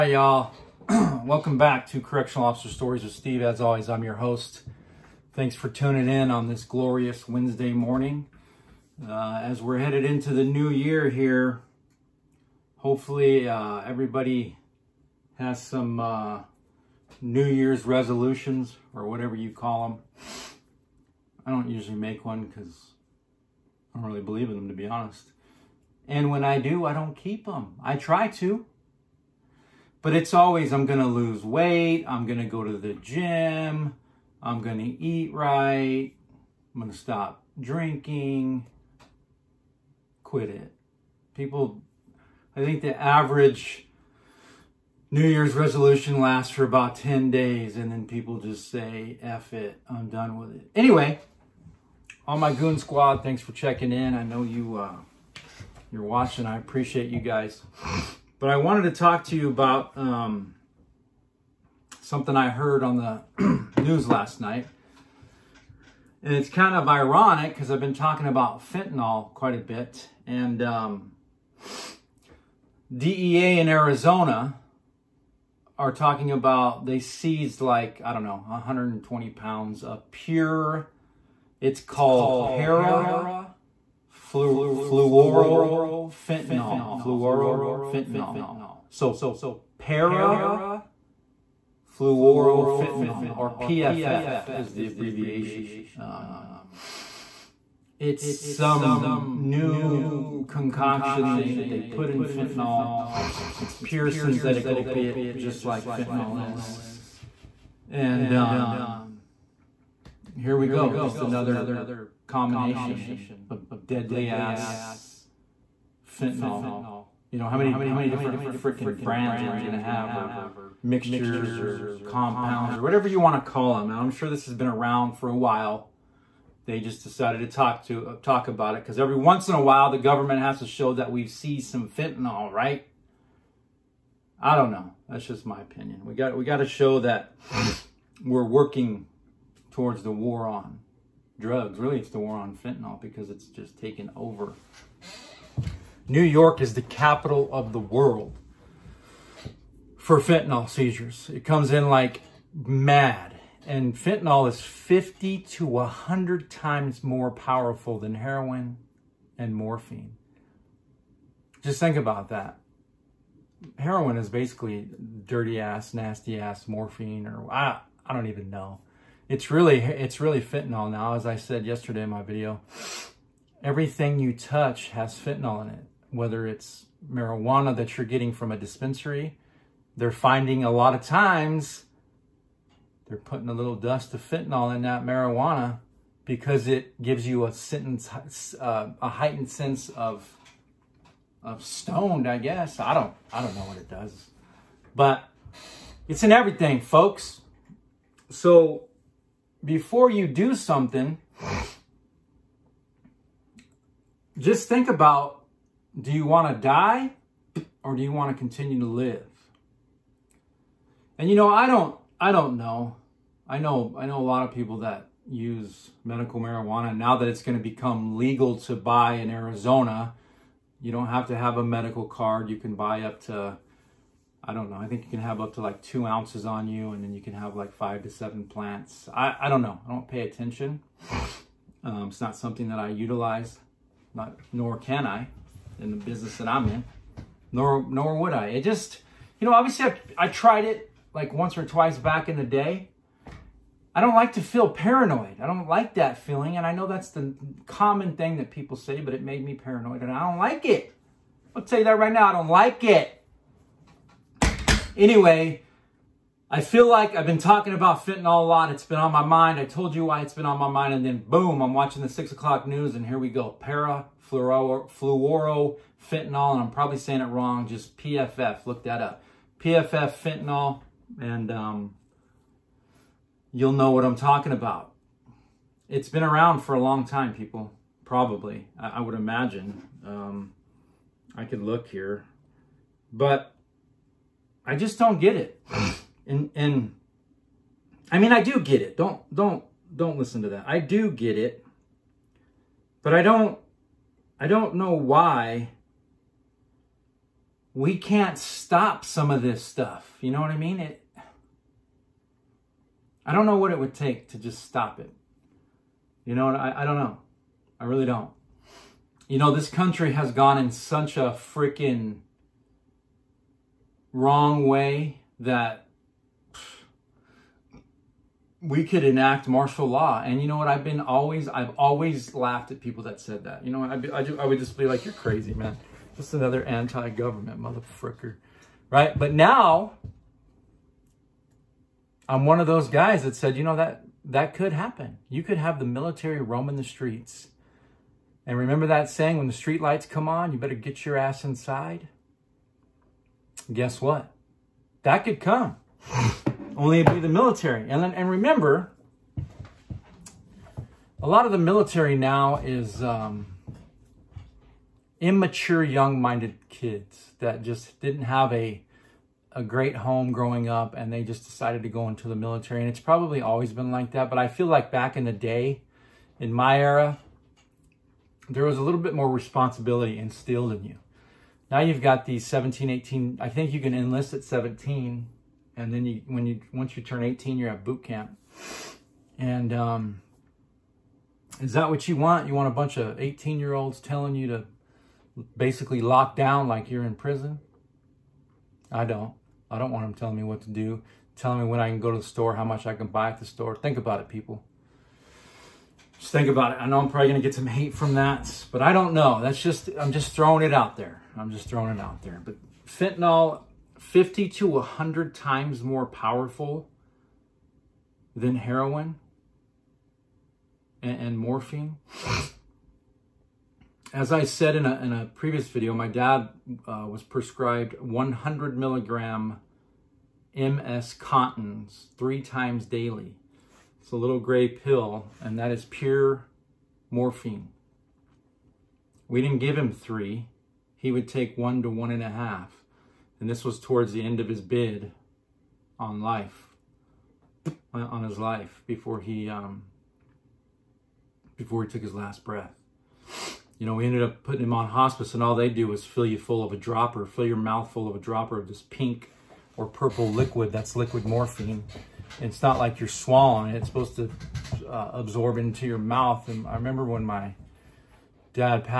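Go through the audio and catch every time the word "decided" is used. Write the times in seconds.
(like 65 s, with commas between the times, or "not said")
127 s, 361 s.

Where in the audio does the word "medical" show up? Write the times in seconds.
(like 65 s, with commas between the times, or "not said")
216 s, 221 s.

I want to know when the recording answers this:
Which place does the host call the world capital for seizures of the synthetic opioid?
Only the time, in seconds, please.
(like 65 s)
146 s.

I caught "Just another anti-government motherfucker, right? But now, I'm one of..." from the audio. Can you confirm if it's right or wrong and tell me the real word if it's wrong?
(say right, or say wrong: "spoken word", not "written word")
right.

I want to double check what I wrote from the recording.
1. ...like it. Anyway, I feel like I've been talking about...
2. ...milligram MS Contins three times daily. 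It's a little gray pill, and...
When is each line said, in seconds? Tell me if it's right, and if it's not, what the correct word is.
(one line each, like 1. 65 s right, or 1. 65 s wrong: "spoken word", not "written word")
1. 252 s right
2. 418 s right.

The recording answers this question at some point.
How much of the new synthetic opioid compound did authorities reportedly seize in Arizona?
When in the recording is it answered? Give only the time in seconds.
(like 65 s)
78 s.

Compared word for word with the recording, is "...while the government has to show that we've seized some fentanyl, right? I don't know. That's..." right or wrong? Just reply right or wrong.
right.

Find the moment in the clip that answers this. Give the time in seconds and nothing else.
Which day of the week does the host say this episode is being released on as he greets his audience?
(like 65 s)
7 s.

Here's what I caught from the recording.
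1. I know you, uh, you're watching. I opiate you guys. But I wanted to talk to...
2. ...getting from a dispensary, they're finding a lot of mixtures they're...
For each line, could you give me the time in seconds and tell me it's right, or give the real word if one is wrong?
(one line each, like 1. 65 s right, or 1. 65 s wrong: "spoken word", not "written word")
1. 54 s wrong: "appreciate", not "opiate"
2. 178 s wrong: "times", not "mixtures".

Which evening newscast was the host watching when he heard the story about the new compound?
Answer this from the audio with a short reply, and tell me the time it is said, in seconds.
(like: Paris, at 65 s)
6 o'clock news, at 262 s.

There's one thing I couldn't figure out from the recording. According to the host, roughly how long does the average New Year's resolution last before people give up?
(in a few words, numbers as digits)
10 days.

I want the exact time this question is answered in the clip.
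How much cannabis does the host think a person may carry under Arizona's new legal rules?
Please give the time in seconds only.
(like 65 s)
225 s.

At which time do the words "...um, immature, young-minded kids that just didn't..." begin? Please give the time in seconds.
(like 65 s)
353 s.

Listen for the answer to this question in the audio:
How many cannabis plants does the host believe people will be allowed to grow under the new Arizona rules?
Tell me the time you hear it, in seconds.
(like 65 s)
227 s.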